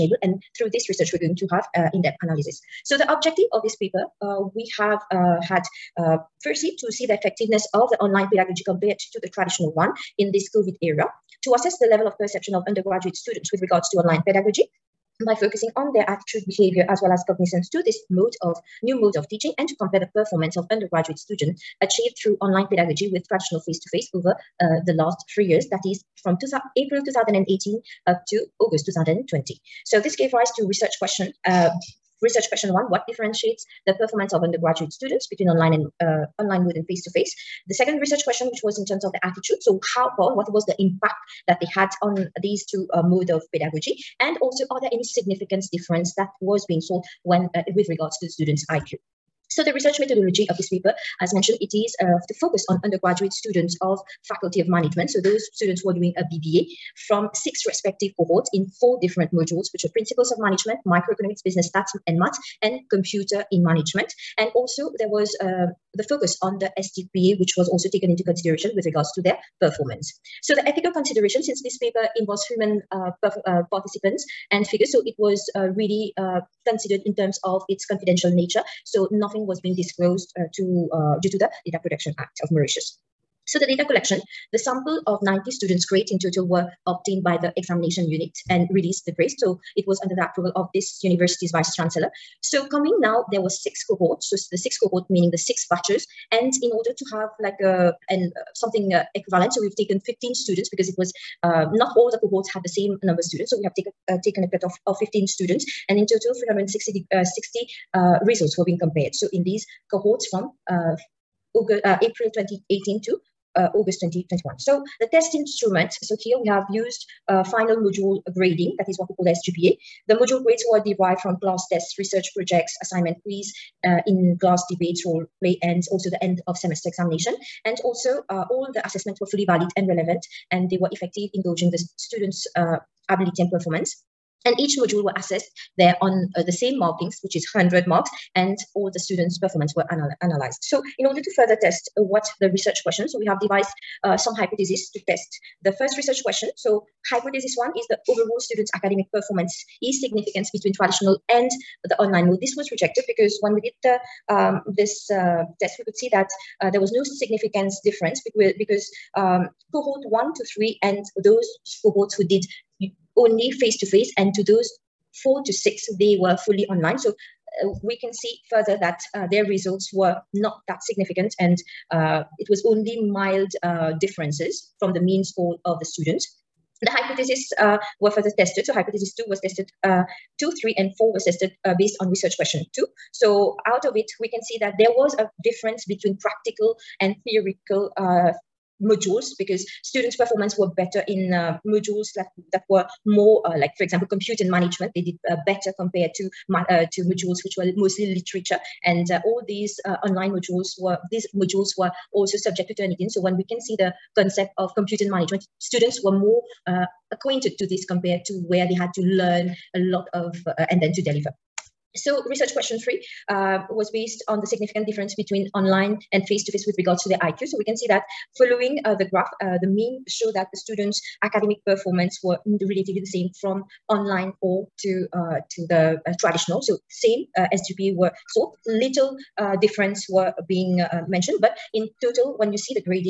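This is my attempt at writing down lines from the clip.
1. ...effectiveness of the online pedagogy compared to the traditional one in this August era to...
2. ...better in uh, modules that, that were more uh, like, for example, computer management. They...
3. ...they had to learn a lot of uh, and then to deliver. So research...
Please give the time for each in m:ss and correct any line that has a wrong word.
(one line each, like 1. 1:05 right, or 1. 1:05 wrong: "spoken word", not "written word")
1. 0:07 wrong: "COVID", not "August"
2. 3:10 right
3. 3:28 right.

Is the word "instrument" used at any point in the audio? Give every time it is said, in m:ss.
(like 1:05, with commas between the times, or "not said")
1:55.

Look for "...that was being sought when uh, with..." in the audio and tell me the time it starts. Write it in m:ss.
0:46.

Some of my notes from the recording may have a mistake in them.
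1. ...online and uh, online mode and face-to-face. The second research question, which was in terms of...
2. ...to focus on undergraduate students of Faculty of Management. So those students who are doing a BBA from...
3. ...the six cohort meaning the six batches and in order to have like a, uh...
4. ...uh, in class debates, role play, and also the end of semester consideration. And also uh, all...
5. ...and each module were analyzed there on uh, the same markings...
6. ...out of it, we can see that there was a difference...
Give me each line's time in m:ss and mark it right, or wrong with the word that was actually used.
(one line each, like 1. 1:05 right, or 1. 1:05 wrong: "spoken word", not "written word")
1. 0:35 right
2. 0:52 right
3. 1:34 right
4. 2:03 wrong: "examination", not "consideration"
5. 2:14 wrong: "assessed", not "analyzed"
6. 3:03 right.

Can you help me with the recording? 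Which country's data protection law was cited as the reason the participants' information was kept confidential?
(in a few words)
Mauritius.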